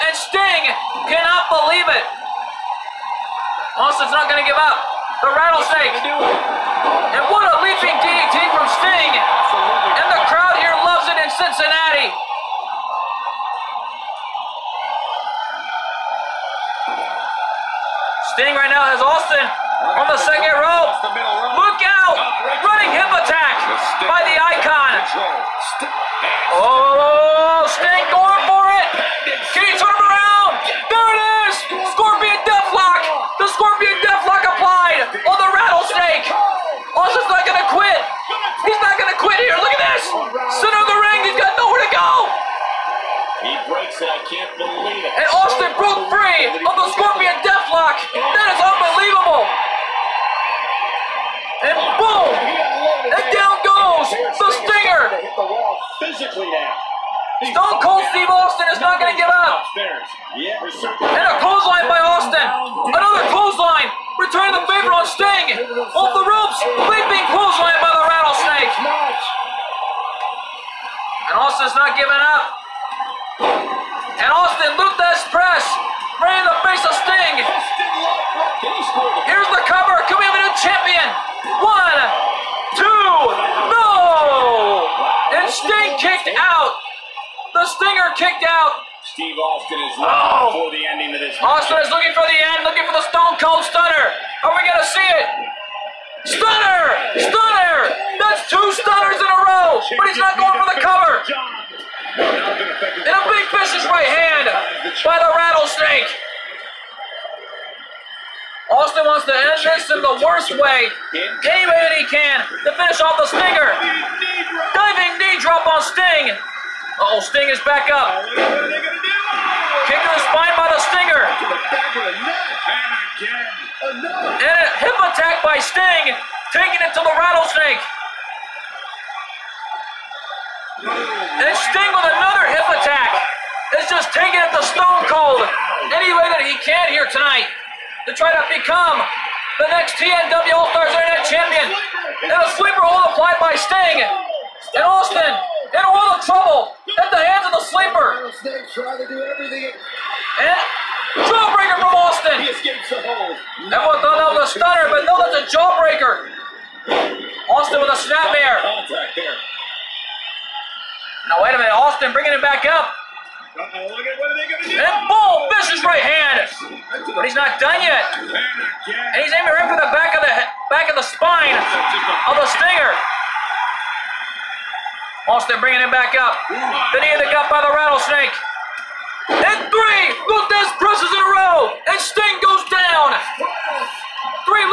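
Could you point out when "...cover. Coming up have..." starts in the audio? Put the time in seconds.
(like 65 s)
79 s.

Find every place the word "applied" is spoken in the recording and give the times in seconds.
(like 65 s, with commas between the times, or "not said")
34 s, 143 s.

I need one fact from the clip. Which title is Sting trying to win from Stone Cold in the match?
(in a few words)
TNW All-Stars Internet Champion.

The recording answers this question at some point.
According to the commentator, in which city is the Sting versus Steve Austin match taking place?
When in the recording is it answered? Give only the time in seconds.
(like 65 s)
11 s.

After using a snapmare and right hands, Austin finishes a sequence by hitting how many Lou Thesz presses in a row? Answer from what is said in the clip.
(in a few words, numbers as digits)
3.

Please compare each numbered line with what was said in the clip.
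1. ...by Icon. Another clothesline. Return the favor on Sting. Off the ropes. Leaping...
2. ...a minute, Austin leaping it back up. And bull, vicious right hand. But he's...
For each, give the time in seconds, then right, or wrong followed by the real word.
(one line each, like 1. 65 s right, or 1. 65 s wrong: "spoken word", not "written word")
1. 61 s wrong: "Austin", not "Icon"
2. 161 s wrong: "bringing", not "leaping".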